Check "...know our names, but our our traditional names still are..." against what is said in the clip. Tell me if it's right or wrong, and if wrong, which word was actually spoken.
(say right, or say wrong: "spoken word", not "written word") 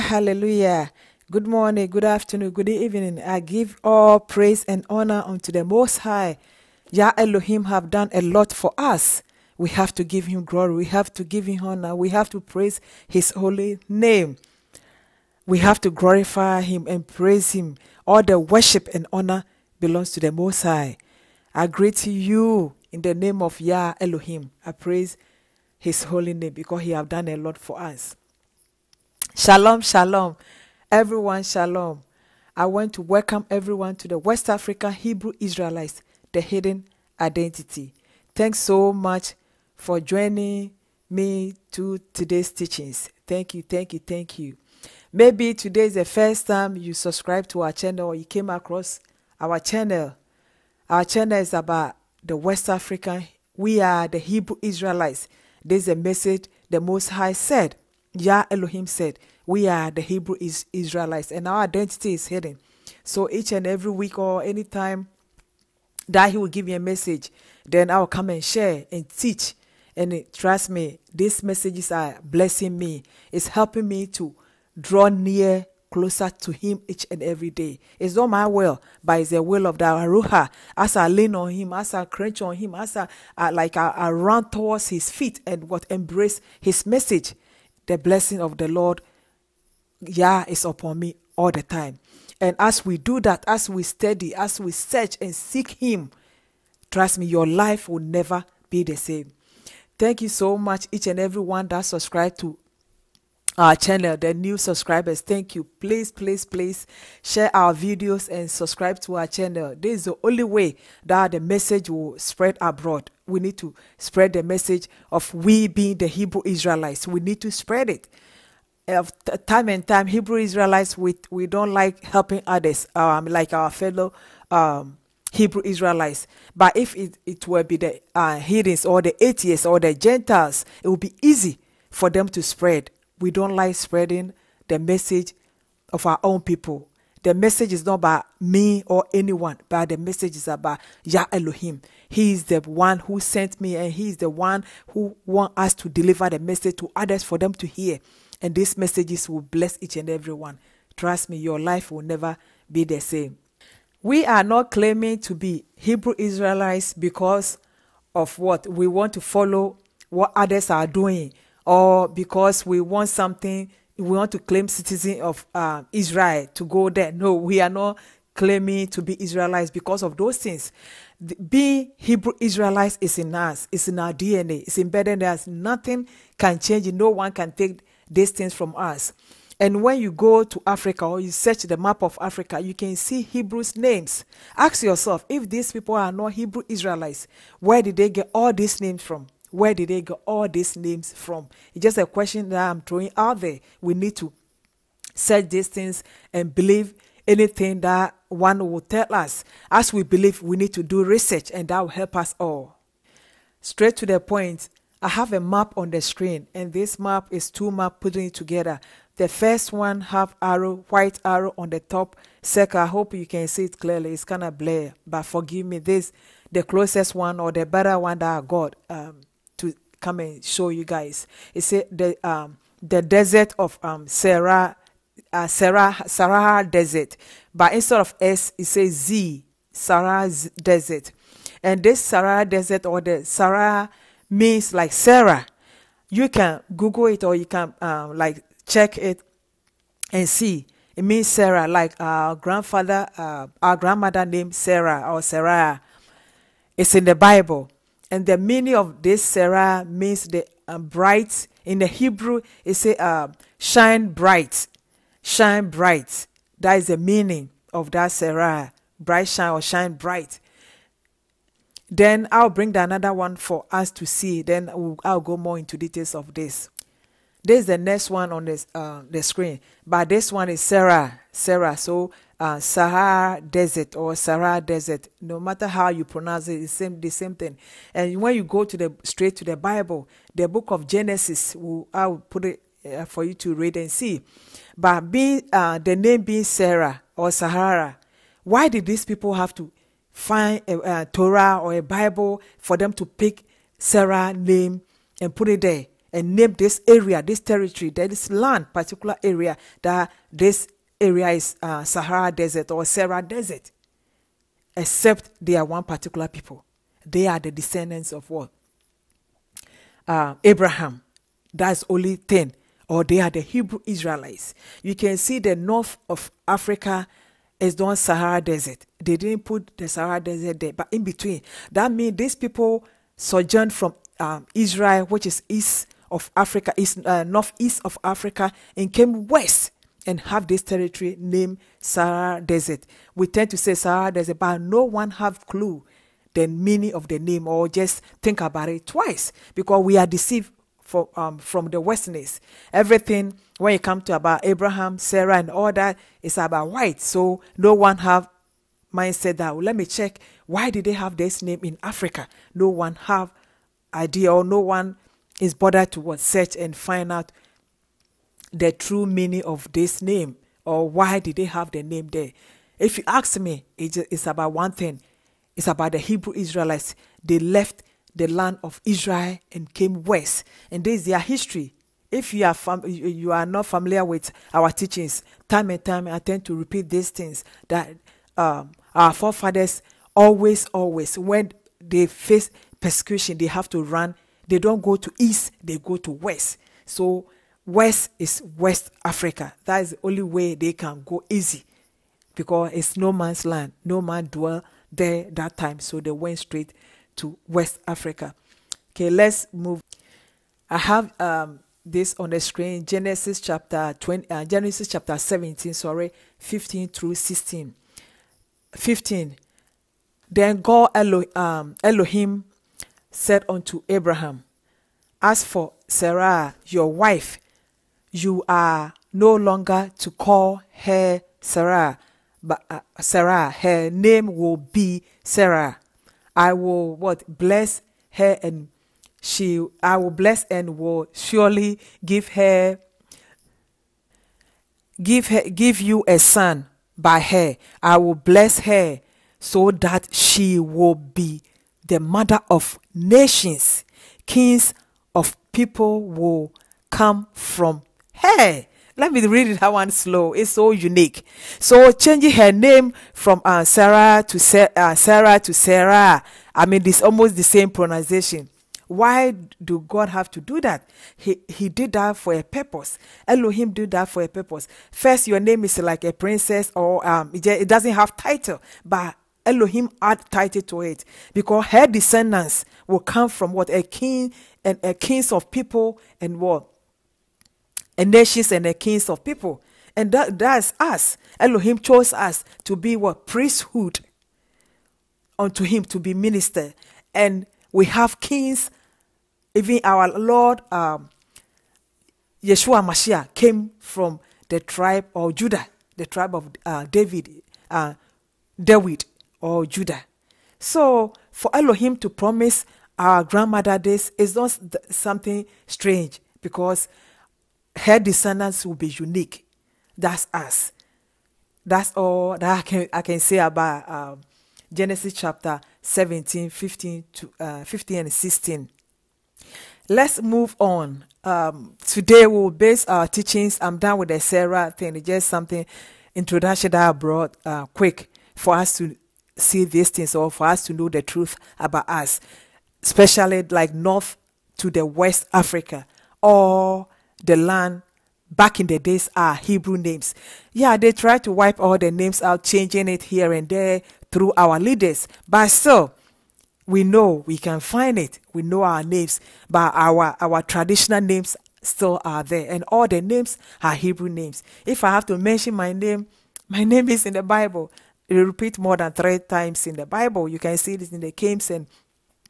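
right.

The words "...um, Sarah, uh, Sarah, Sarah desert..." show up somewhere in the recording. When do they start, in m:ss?
3:43.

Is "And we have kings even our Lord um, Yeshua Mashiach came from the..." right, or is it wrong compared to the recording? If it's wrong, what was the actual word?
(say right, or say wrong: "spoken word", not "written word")
right.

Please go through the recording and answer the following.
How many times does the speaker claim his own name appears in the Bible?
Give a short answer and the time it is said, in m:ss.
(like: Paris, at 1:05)
More than 3, at 9:18.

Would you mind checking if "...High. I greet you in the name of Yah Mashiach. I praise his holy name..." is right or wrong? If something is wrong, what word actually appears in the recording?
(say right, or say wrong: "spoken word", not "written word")
wrong: "Elohim", not "Mashiach".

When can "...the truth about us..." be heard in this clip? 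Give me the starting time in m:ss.
8:50.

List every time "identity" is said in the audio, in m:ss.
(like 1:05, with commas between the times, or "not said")
0:37, 1:01.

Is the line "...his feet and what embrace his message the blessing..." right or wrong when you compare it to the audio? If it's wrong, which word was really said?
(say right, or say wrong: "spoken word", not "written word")
right.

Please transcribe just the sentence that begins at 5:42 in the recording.
Everything when you come to about Abraham, Sarah, and all that, it's about white.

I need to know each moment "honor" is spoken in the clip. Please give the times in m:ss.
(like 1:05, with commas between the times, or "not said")
0:04, 0:11, 0:19.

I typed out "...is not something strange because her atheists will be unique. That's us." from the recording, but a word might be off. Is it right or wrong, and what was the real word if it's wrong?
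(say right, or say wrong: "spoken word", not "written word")
wrong: "descendants", not "atheists".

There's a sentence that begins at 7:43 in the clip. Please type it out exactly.
Elohim did that for a purpose.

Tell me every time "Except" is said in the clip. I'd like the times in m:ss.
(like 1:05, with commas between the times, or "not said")
5:04.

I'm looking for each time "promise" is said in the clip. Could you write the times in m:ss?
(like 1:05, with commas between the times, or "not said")
8:22.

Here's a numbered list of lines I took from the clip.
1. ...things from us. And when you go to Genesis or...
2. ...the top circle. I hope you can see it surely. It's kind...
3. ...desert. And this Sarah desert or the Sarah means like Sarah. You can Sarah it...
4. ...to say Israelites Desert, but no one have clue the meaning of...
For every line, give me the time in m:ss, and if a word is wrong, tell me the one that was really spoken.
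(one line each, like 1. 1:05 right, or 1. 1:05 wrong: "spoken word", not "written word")
1. 2:58 wrong: "Africa", not "Genesis"
2. 3:31 wrong: "clearly", not "surely"
3. 3:50 wrong: "Google", not "Sarah"
4. 5:33 wrong: "Sahara", not "Israelites".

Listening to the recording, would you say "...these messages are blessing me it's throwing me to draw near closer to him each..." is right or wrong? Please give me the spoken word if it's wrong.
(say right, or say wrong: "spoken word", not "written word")
wrong: "helping", not "throwing".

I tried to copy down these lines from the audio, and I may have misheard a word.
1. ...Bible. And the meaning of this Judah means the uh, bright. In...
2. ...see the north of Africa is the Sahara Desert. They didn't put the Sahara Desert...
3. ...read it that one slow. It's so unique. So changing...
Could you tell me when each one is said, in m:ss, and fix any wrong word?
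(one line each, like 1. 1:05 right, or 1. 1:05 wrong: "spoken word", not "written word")
1. 4:07 wrong: "Sarah", not "Judah"
2. 5:15 right
3. 7:29 right.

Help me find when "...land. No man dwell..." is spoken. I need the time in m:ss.
6:33.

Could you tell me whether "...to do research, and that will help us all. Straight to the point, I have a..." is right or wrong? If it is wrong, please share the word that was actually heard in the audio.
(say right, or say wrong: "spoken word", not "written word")
right.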